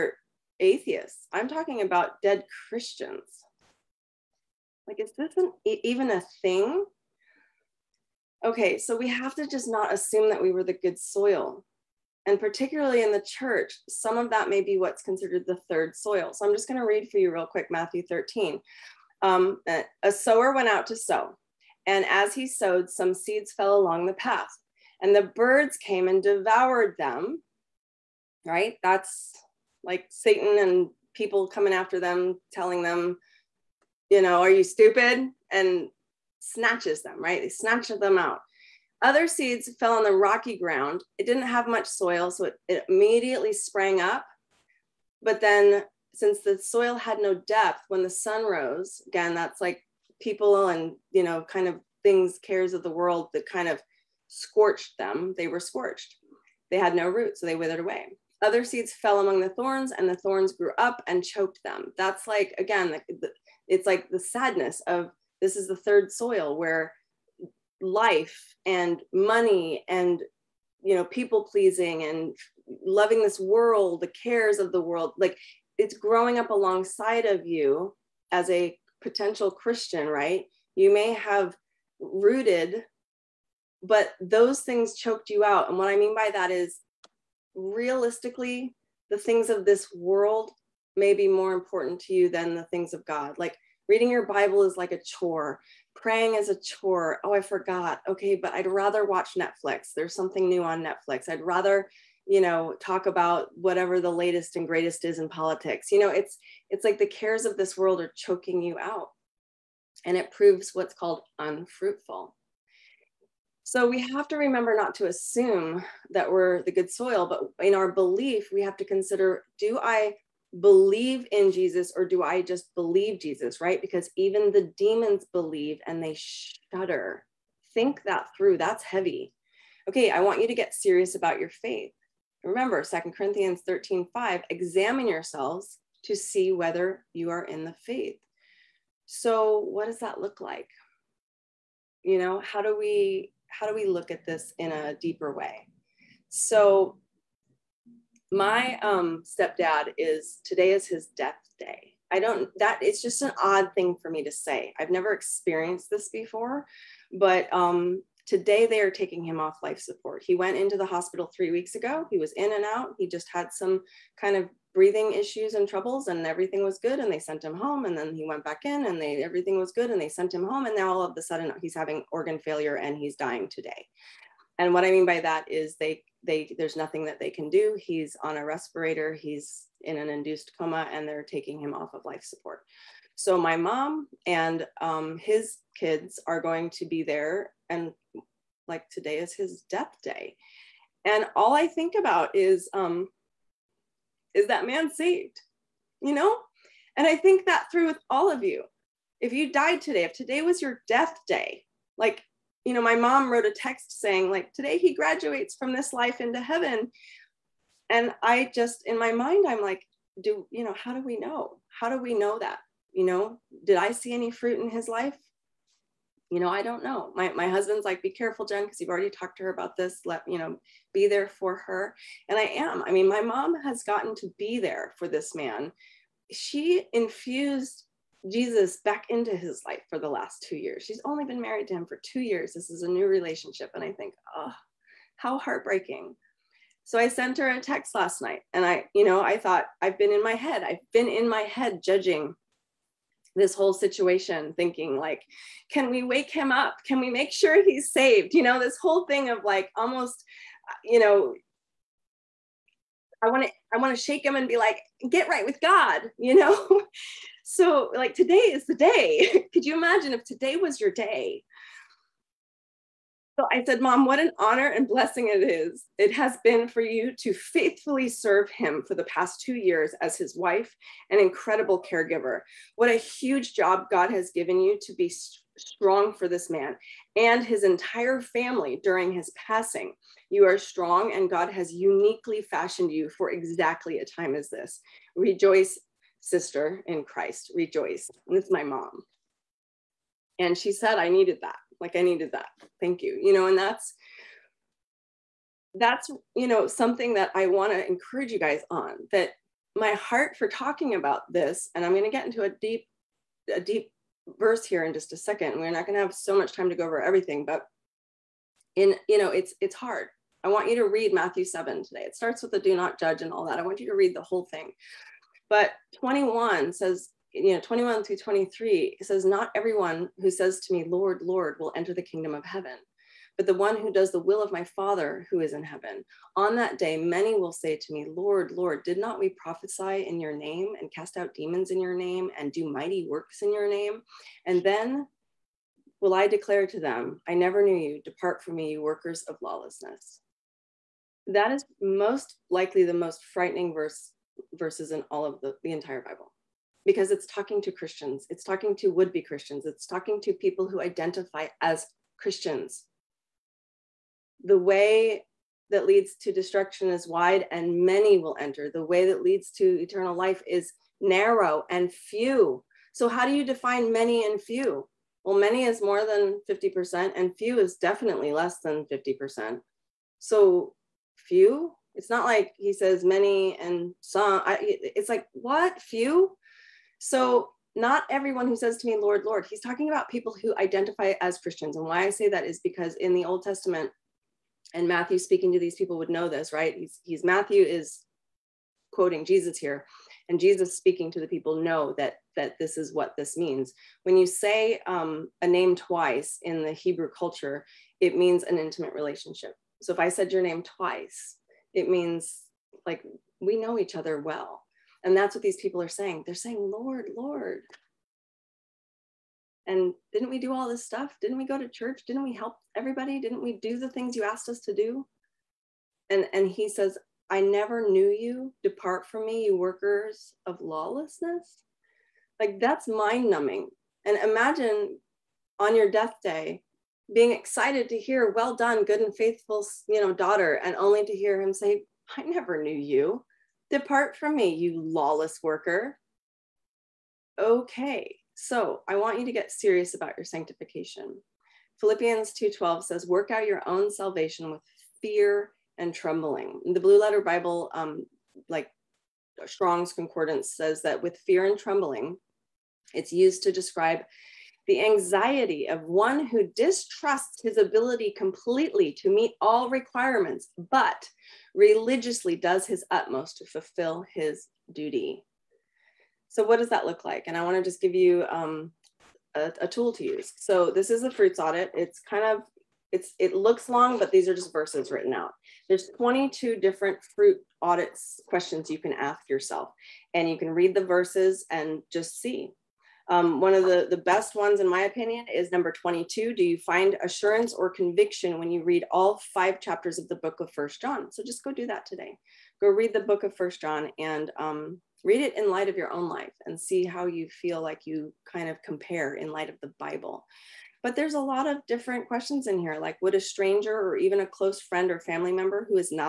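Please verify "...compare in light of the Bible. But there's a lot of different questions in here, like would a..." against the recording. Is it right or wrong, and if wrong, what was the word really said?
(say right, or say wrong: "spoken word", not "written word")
right.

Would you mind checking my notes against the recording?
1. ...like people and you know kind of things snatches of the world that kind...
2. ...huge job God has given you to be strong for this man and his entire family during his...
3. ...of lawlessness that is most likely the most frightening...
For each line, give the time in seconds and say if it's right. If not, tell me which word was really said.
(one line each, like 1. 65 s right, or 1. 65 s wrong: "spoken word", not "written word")
1. 49 s wrong: "cares", not "snatches"
2. 272 s right
3. 339 s right.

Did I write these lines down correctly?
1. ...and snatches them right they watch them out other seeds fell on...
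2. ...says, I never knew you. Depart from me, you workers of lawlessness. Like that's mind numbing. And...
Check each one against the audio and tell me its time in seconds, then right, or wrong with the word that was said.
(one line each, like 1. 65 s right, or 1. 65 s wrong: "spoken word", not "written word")
1. 35 s wrong: "snatch", not "watch"
2. 416 s right.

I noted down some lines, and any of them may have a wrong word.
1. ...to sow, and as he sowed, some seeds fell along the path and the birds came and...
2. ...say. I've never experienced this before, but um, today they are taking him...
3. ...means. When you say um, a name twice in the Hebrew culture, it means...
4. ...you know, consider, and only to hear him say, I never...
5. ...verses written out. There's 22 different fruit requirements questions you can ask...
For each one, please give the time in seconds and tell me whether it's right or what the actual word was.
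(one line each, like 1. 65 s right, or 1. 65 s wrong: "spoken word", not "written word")
1. 20 s right
2. 154 s right
3. 393 s right
4. 429 s wrong: "daughter", not "consider"
5. 474 s wrong: "audits", not "requirements".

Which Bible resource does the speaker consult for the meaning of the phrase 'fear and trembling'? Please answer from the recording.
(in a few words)
Blue Letter Bible.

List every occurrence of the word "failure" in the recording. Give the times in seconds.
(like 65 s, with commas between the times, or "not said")
172 s.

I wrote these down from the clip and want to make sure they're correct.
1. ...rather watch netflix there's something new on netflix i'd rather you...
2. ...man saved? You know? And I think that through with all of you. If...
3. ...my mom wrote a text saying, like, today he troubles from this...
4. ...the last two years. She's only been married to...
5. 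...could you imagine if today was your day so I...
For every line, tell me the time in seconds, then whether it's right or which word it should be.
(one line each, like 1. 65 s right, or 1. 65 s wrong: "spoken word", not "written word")
1. 98 s right
2. 194 s right
3. 202 s wrong: "graduates", not "troubles"
4. 229 s right
5. 259 s right.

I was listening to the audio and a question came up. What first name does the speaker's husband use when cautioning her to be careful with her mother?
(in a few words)
Jen.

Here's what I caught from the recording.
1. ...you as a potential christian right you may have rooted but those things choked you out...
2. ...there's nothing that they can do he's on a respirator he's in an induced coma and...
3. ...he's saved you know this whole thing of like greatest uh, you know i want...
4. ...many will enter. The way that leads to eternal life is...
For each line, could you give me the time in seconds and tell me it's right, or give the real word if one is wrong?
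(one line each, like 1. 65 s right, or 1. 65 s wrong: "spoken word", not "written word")
1. 77 s right
2. 176 s right
3. 247 s wrong: "almost", not "greatest"
4. 357 s right.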